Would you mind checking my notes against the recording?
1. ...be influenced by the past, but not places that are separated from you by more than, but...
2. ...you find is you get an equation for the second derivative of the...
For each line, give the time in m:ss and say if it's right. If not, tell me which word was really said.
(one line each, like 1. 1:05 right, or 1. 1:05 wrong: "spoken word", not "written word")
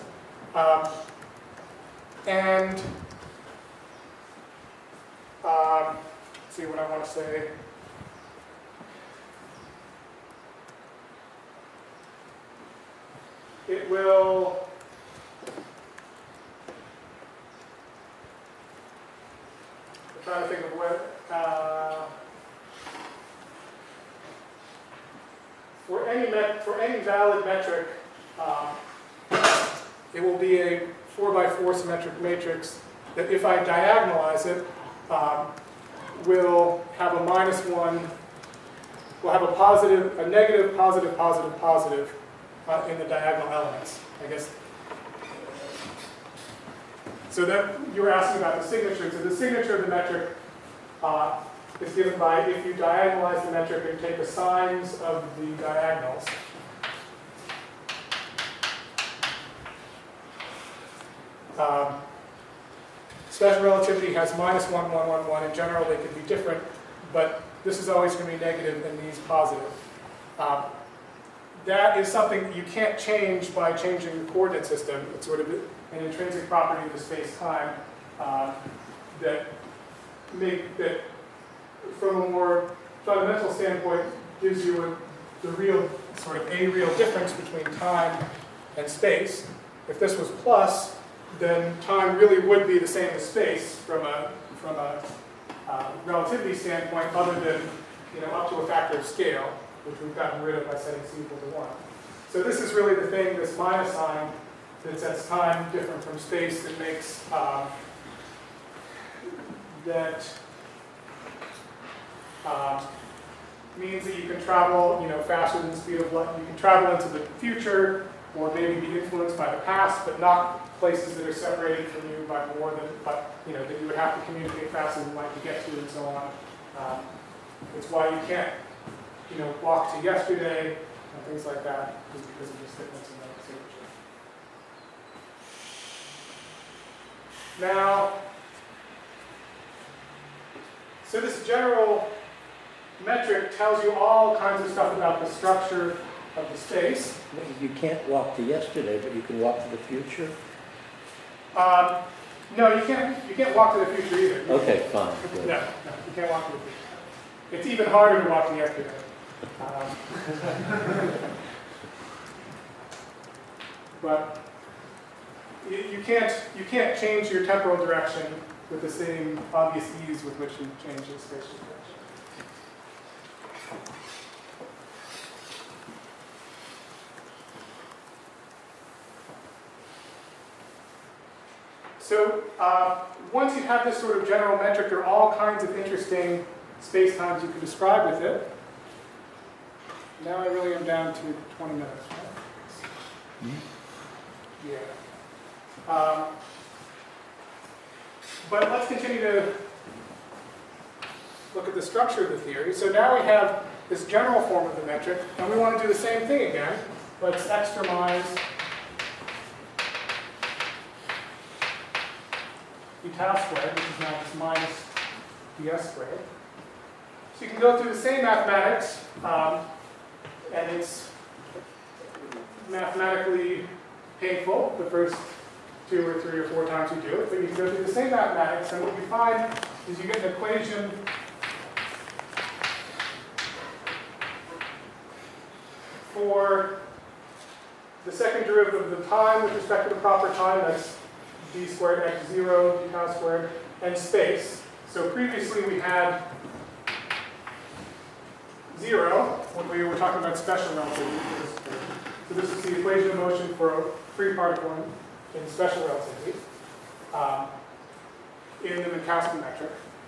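1. 1:58 right
2. 3:48 right.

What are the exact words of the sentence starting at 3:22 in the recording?
So now we have this general form of the metric, and we want to do the same thing again.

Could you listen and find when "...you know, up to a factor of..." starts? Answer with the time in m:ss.
1:38.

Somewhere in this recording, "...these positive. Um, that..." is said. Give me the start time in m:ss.
1:08.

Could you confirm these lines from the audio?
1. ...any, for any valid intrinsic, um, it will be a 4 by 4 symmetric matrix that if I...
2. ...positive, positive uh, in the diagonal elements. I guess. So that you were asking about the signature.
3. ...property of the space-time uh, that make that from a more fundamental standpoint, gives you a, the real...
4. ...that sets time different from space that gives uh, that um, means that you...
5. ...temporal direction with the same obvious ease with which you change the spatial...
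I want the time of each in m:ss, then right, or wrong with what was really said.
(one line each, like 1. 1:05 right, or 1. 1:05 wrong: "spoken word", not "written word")
1. 0:26 wrong: "metric", not "intrinsic"
2. 0:41 right
3. 1:16 right
4. 1:44 wrong: "makes", not "gives"
5. 2:47 right.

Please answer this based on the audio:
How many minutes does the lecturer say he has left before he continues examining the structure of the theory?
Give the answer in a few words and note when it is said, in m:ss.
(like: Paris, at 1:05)
20, at 3:11.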